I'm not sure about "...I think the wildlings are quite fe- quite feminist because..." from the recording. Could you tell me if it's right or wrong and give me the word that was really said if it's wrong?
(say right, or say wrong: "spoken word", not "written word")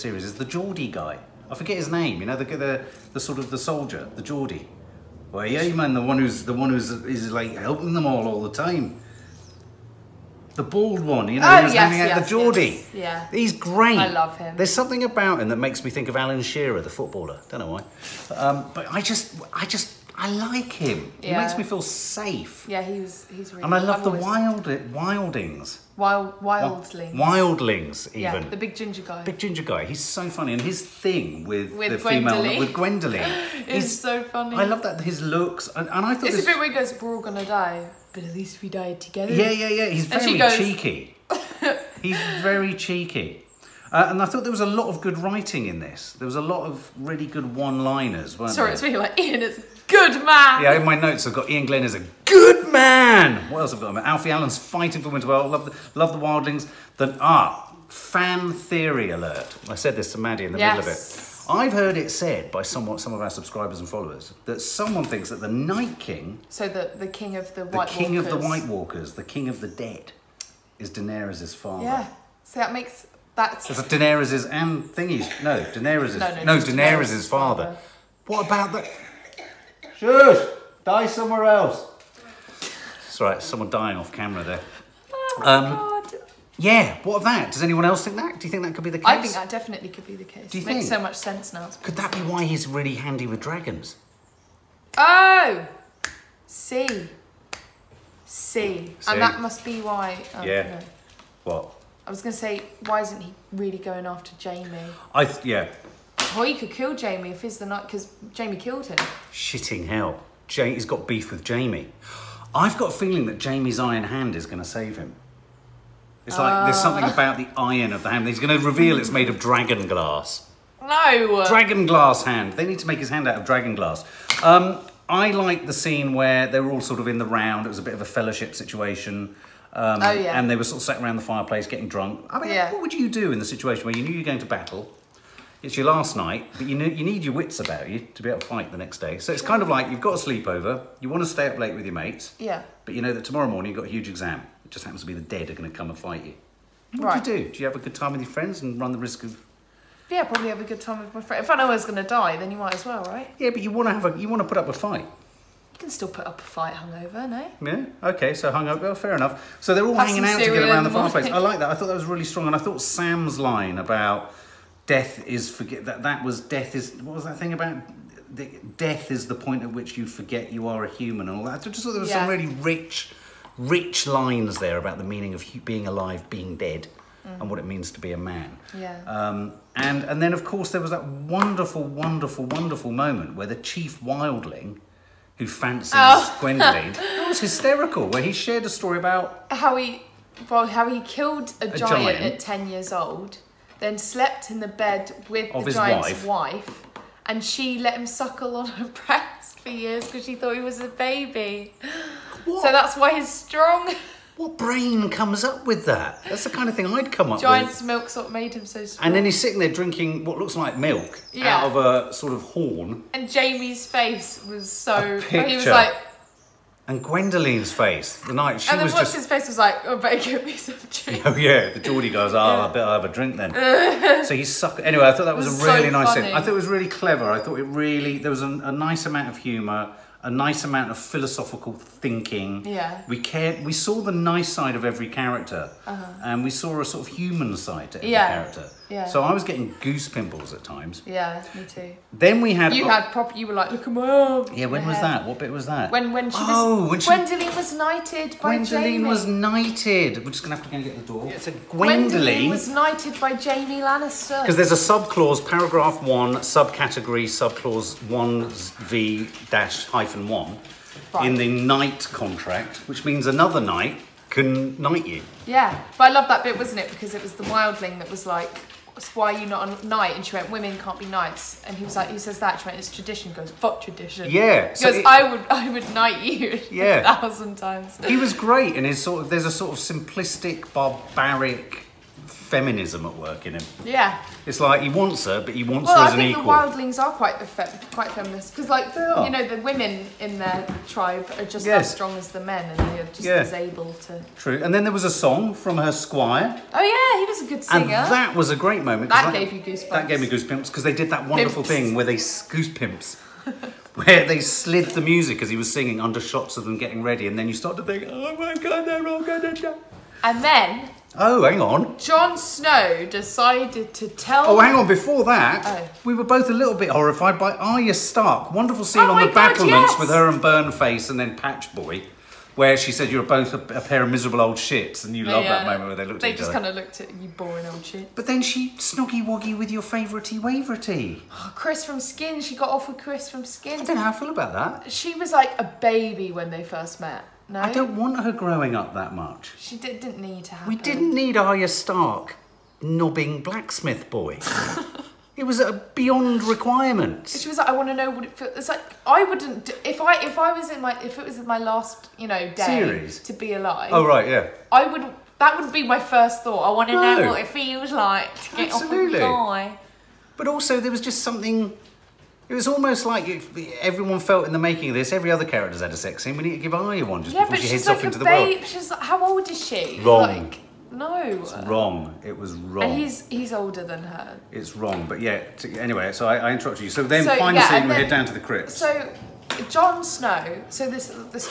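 right.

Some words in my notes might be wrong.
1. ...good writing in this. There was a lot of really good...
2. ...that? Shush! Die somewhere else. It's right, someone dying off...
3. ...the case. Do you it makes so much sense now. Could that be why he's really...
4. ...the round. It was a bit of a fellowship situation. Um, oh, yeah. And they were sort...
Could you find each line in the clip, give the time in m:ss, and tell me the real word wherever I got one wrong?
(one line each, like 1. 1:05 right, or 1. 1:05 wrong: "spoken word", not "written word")
1. 0:45 right
2. 1:18 right
3. 1:30 right
4. 2:07 right.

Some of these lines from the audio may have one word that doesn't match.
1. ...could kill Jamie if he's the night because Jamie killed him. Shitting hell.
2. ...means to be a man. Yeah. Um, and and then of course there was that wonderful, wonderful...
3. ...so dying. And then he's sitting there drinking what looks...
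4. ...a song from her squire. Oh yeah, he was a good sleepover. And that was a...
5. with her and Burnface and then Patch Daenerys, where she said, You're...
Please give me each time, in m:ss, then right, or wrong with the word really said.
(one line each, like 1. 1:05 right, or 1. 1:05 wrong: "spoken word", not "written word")
1. 1:46 right
2. 2:57 right
3. 3:28 wrong: "strong", not "dying"
4. 4:55 wrong: "singer", not "sleepover"
5. 5:19 wrong: "Boy", not "Daenerys".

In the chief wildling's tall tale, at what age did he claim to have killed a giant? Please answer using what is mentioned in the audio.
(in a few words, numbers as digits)
10.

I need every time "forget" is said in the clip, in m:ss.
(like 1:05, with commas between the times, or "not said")
0:01, 2:45, 2:50.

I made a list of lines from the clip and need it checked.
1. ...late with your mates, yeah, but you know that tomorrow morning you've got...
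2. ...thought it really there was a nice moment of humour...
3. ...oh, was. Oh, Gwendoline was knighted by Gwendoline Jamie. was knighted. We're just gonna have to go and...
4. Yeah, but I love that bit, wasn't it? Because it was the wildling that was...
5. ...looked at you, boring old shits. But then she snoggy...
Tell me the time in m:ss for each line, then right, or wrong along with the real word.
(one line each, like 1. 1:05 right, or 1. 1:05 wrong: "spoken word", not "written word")
1. 2:21 right
2. 3:47 wrong: "amount", not "moment"
3. 4:06 right
4. 4:25 right
5. 5:26 right.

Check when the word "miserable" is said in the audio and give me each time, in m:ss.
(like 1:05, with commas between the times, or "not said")
5:24.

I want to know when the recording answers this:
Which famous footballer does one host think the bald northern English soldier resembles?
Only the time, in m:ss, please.
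0:16.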